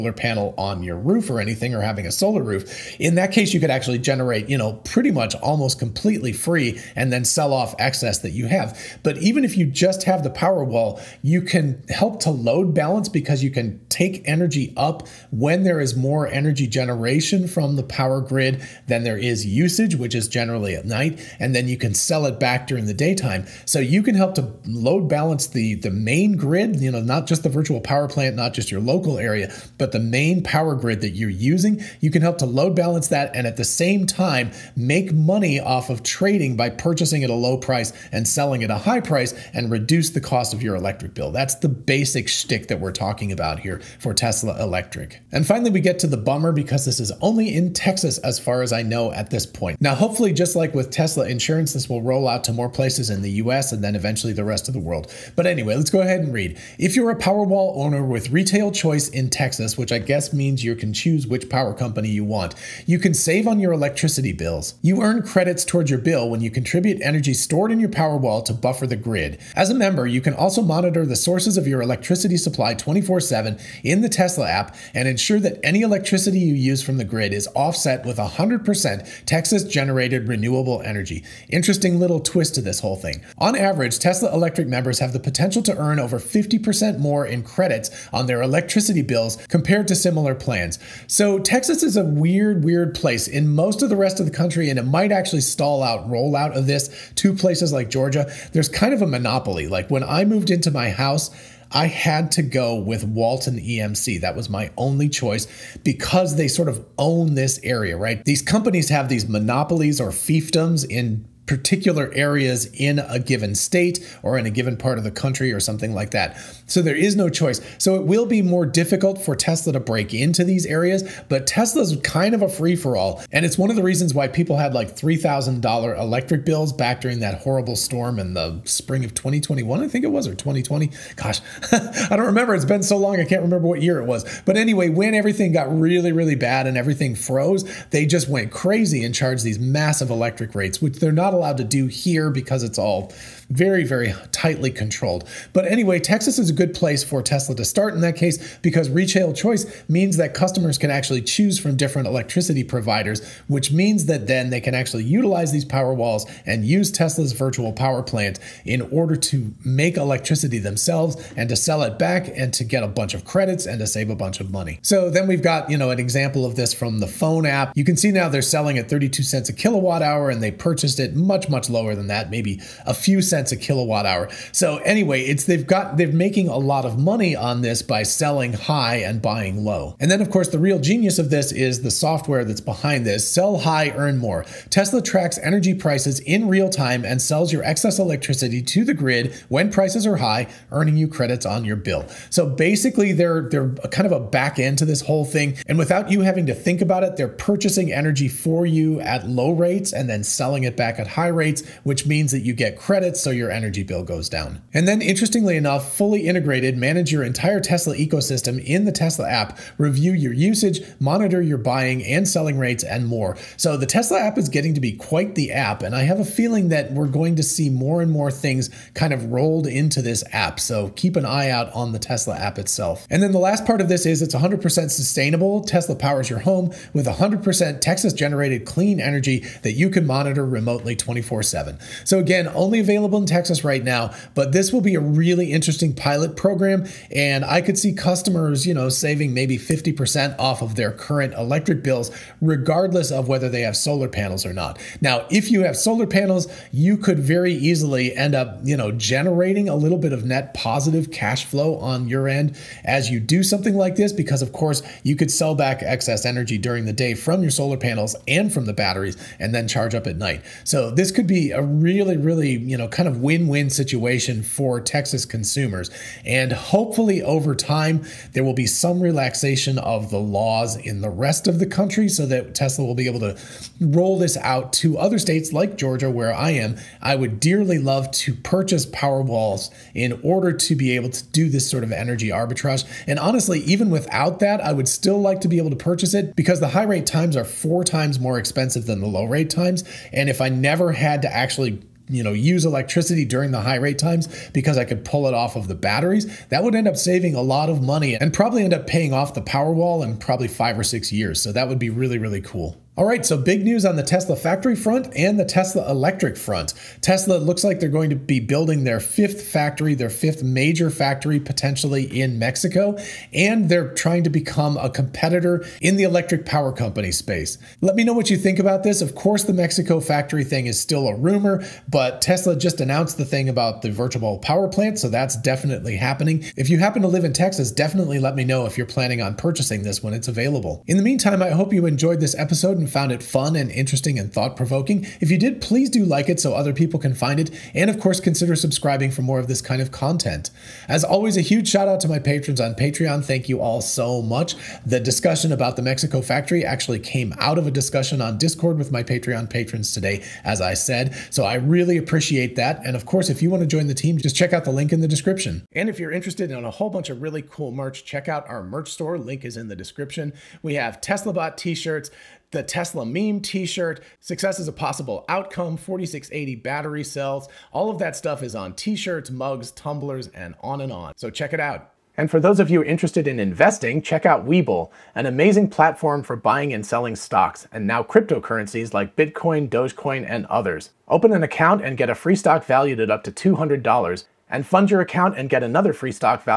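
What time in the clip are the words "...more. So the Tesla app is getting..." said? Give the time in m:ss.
3:33.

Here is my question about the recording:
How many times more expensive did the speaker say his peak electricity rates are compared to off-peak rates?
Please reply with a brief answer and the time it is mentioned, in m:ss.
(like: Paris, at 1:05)
4 times, at 4:47.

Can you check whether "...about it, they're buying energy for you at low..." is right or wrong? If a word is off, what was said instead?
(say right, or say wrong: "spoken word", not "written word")
wrong: "purchasing", not "buying".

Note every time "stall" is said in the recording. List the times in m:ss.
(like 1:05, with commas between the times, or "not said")
1:35.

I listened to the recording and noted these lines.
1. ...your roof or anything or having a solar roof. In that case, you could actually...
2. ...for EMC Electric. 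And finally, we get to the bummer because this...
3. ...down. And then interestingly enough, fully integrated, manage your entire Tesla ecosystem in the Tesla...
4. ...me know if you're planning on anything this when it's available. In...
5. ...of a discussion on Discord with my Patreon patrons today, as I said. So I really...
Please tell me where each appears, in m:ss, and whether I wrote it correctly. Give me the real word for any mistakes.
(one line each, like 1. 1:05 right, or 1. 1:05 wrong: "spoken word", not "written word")
1. 0:00 right
2. 0:43 wrong: "Tesla", not "EMC"
3. 3:24 right
4. 5:28 wrong: "purchasing", not "anything"
5. 5:47 right.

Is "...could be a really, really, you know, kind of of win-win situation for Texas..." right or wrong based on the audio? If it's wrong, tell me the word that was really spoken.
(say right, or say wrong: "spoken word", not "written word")
right.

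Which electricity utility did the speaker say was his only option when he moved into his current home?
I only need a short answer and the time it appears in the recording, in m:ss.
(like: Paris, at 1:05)
Walton EMC, at 1:43.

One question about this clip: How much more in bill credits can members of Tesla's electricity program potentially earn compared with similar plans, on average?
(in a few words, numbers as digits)
over 50%.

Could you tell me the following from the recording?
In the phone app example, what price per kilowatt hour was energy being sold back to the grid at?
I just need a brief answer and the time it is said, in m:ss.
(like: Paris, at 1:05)
32 cents, at 2:48.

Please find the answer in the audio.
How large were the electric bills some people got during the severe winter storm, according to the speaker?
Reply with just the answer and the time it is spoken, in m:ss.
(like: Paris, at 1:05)
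$3,000, at 2:04.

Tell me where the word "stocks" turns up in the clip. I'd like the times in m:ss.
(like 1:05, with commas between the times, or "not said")
6:17, 6:22.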